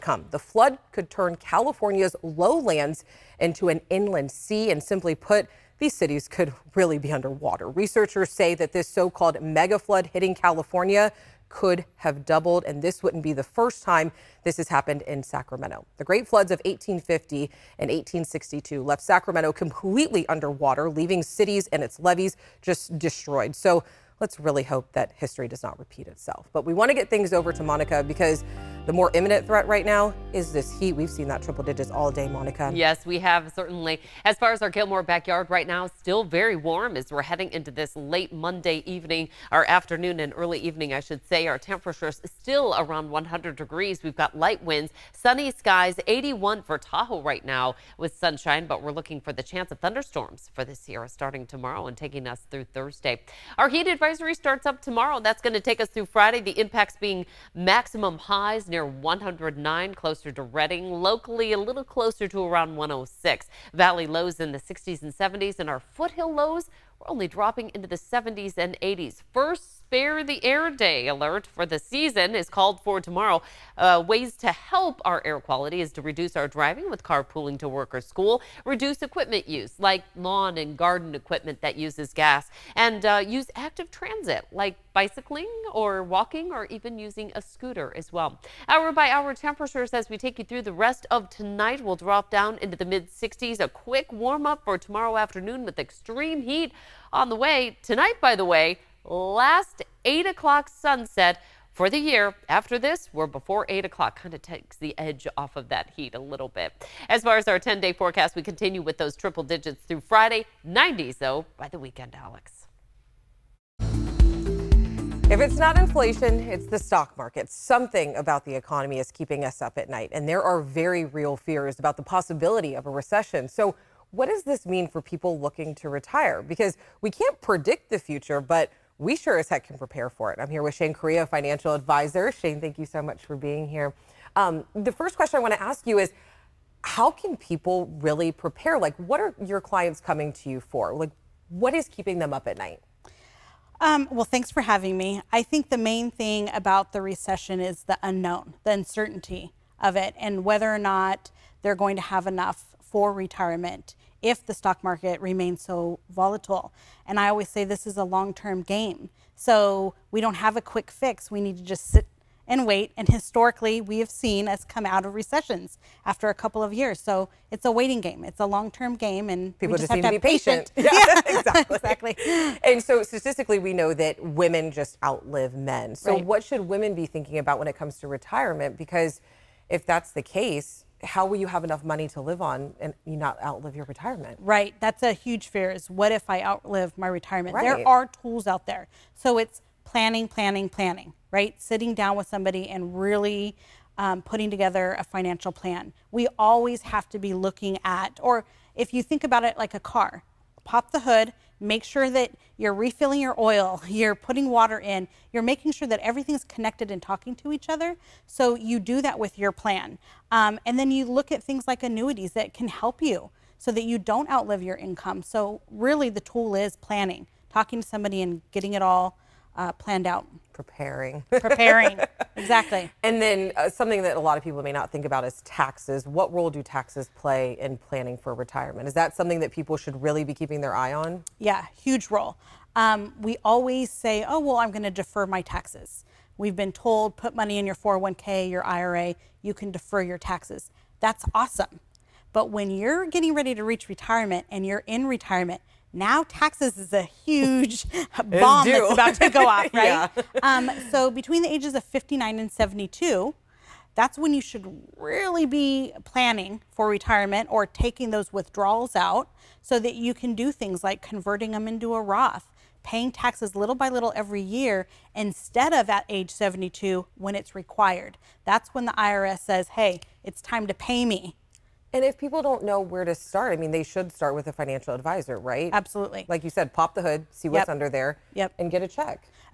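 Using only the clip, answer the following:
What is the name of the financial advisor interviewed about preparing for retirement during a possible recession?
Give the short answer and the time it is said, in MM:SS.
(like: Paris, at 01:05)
Shane Correa, at 02:10.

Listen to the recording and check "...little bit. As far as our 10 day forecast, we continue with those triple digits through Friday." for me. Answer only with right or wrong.
right.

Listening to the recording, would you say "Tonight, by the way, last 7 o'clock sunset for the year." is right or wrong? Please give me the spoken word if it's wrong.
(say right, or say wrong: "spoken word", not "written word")
wrong: "8", not "7".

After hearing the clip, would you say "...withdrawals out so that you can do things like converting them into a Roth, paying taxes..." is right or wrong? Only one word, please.
right.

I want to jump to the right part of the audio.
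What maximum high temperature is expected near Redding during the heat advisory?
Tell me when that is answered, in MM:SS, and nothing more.
00:58.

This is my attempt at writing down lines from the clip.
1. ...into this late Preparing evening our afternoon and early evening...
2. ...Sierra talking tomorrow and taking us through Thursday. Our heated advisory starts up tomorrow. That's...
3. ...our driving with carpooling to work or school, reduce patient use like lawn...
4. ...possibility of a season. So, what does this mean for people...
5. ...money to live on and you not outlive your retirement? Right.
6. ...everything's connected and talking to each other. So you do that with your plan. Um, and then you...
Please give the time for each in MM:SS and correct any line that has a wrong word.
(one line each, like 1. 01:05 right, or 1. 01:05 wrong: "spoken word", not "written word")
1. 00:37 wrong: "Monday", not "Preparing"
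2. 00:50 wrong: "starting", not "talking"
3. 01:16 wrong: "equipment", not "patient"
4. 02:02 wrong: "recession", not "season"
5. 03:01 right
6. 03:25 right.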